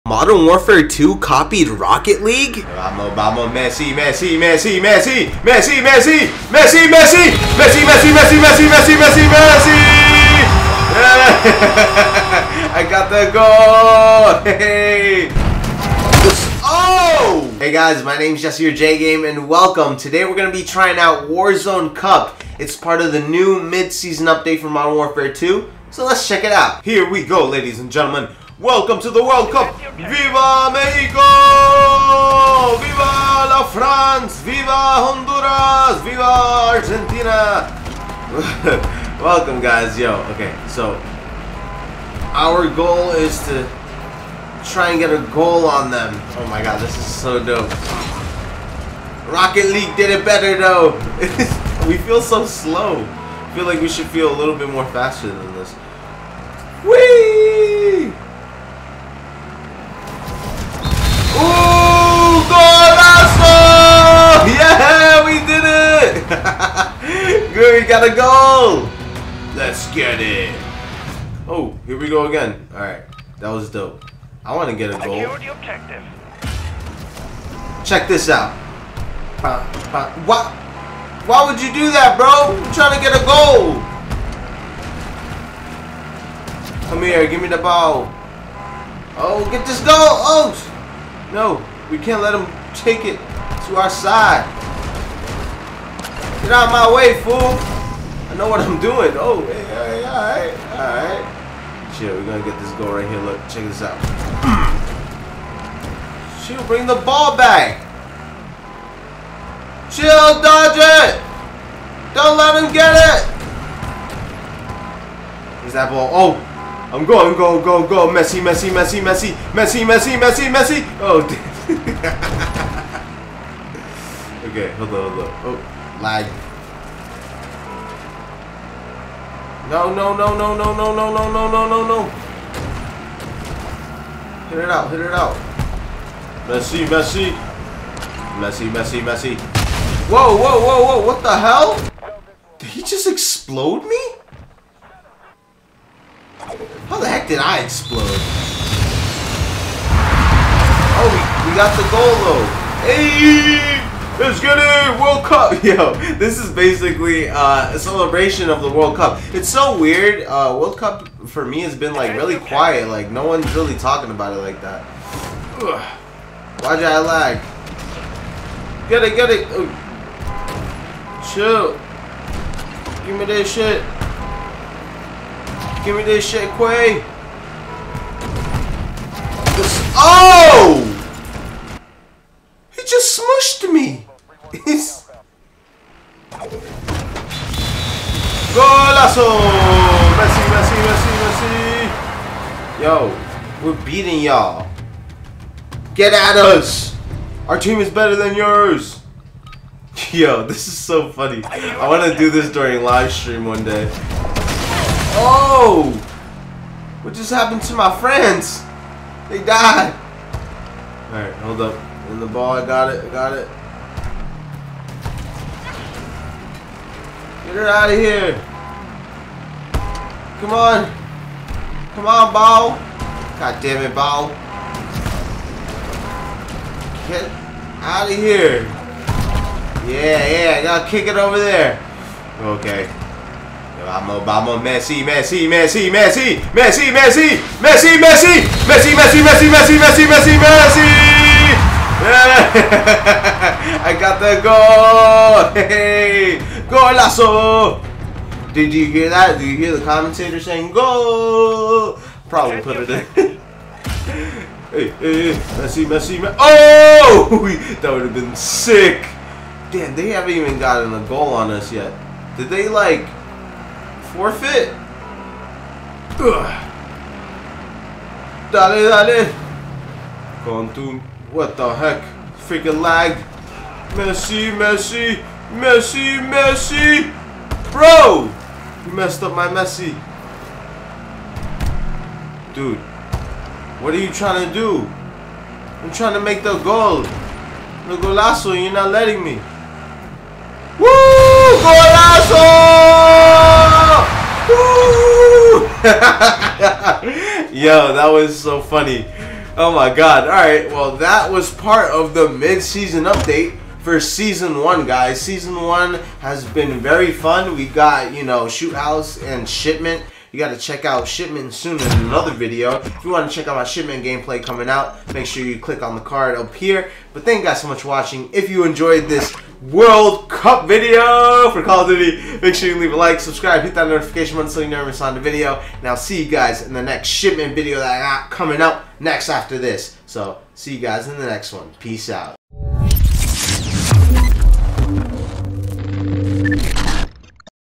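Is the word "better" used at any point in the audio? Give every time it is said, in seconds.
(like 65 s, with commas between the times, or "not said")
50 s, 197 s.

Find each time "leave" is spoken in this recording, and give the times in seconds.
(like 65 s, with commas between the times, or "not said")
322 s.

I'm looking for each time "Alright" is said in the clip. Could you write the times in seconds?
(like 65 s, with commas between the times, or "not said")
72 s, 211 s, 300 s.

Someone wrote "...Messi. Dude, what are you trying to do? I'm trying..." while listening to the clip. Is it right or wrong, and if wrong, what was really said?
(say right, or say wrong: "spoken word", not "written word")
right.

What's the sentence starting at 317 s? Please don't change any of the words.
But thank you guys so much for watching.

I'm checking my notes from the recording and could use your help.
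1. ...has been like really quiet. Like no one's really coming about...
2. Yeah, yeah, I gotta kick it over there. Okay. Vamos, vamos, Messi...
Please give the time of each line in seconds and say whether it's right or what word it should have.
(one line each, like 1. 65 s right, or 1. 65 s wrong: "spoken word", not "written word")
1. 161 s wrong: "talking", not "coming"
2. 229 s right.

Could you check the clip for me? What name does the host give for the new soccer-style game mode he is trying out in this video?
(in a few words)
Warzone Cup.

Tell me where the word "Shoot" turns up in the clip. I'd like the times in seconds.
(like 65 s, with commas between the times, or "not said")
308 s.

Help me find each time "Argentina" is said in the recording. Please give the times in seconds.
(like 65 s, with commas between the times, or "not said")
37 s.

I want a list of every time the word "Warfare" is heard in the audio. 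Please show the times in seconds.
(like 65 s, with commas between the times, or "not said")
0 s, 24 s.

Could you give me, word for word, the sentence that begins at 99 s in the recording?
Oh, hey, all right, all right.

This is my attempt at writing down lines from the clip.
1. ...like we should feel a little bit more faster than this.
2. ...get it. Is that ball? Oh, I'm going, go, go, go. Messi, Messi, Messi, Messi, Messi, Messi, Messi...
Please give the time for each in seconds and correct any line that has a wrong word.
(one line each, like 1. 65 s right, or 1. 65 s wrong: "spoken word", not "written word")
1. 53 s right
2. 112 s right.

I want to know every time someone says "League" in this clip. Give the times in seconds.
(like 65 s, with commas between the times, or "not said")
2 s, 49 s.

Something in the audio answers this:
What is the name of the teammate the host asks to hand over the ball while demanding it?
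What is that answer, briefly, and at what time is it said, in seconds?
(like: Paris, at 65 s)
Quay, at 176 s.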